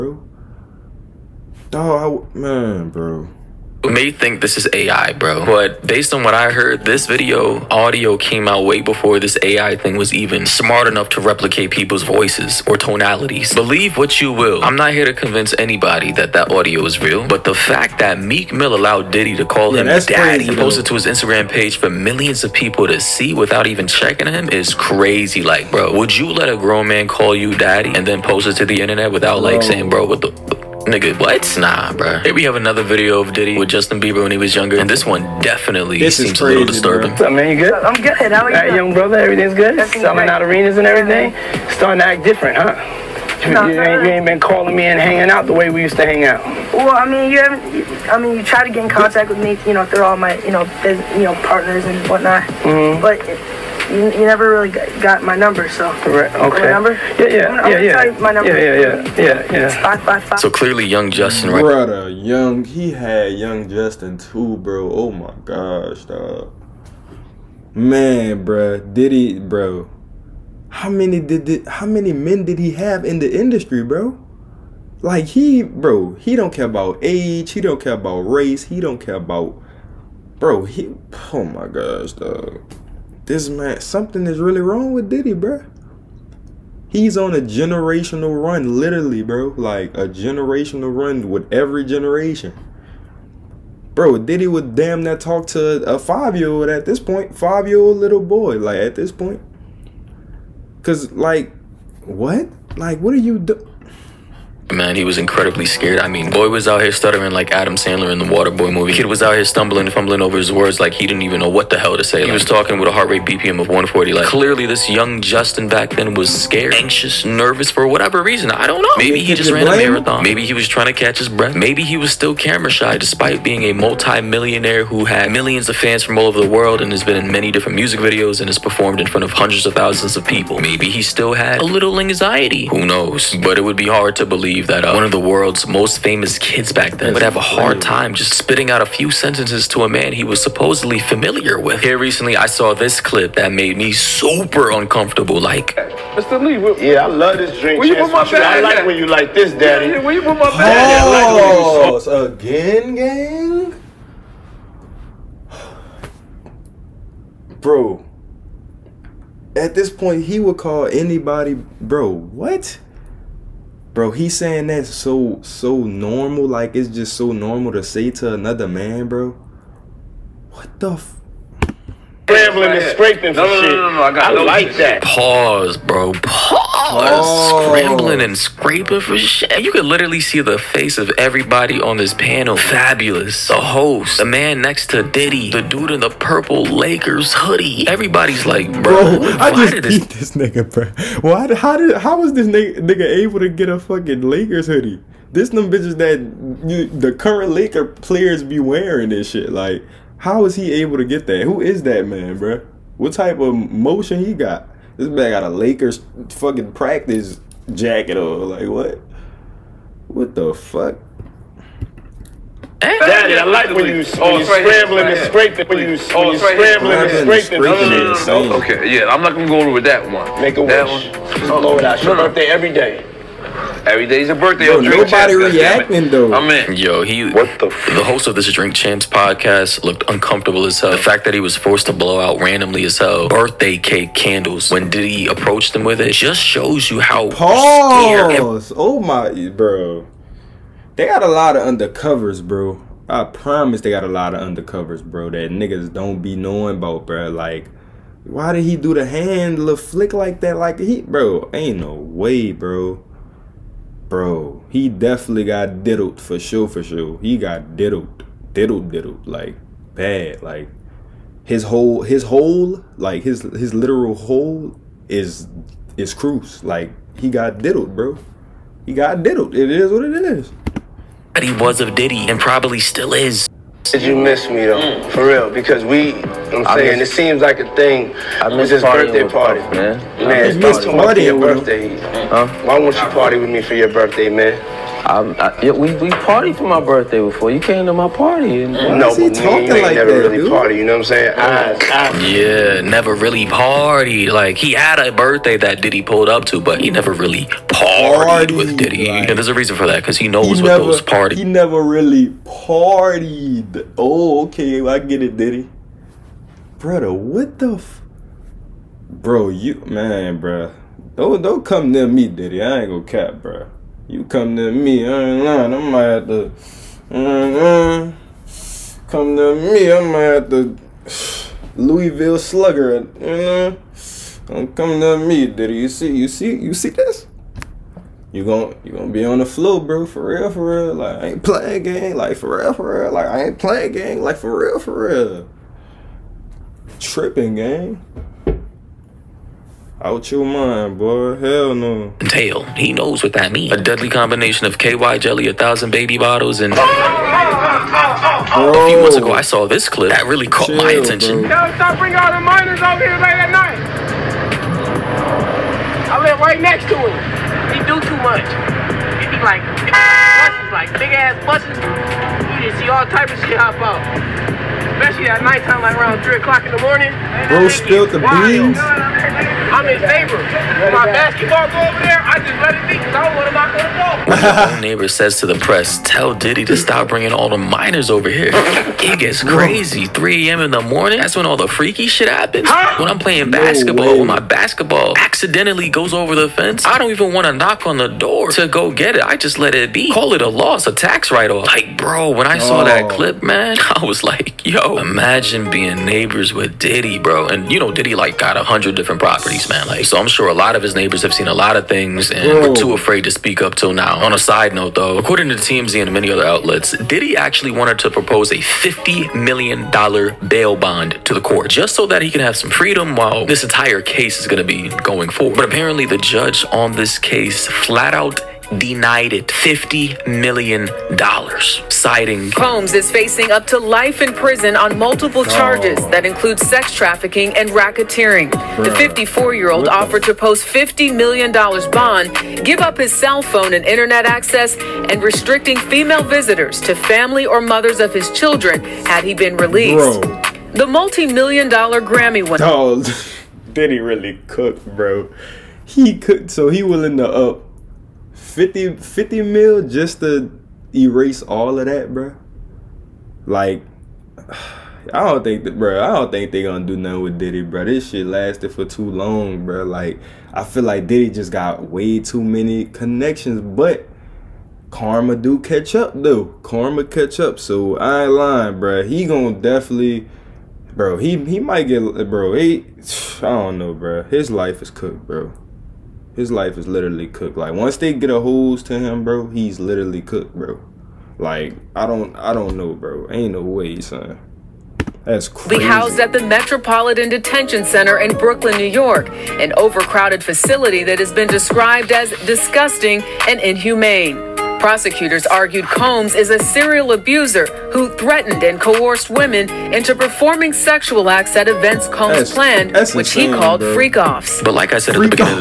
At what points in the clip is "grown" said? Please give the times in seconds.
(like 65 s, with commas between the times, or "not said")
26 s.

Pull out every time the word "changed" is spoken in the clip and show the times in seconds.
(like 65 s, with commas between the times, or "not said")
not said.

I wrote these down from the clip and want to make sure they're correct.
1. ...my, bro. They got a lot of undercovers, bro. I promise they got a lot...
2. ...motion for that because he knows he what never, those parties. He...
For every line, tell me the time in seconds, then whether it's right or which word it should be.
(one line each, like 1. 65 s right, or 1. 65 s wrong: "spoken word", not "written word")
1. 238 s right
2. 299 s wrong: "reason", not "motion".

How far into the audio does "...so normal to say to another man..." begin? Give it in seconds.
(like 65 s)
167 s.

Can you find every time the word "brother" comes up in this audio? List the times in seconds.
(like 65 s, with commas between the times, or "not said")
38 s, 61 s, 306 s.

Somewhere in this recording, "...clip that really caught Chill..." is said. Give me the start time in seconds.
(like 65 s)
349 s.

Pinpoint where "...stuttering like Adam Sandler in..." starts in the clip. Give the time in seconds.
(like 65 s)
106 s.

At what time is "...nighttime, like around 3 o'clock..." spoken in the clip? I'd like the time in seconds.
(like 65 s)
365 s.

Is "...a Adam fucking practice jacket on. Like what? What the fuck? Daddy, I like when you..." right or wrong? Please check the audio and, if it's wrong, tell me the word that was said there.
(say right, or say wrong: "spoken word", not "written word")
wrong: "Lakers", not "Adam".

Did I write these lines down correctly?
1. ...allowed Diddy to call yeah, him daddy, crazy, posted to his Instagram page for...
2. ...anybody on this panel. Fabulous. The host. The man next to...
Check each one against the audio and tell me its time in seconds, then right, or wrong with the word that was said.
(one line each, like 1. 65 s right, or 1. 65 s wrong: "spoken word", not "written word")
1. 18 s right
2. 181 s wrong: "everybody", not "anybody".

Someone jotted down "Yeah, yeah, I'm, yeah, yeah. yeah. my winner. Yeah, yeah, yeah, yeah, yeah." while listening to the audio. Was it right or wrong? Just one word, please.
wrong.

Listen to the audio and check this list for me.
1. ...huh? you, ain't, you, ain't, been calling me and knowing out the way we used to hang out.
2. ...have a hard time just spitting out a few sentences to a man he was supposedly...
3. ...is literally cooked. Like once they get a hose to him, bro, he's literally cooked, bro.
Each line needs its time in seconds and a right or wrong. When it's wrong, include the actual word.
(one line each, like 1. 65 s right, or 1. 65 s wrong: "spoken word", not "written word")
1. 42 s wrong: "hanging", not "knowing"
2. 137 s right
3. 476 s right.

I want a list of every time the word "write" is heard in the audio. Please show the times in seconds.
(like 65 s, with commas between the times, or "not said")
391 s.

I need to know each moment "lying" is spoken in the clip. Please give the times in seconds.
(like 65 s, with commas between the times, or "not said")
315 s, 468 s.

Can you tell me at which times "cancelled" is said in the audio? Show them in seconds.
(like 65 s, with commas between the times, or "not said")
not said.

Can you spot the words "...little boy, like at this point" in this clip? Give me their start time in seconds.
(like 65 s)
97 s.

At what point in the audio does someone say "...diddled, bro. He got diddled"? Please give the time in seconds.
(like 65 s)
267 s.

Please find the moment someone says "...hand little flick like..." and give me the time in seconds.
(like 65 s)
249 s.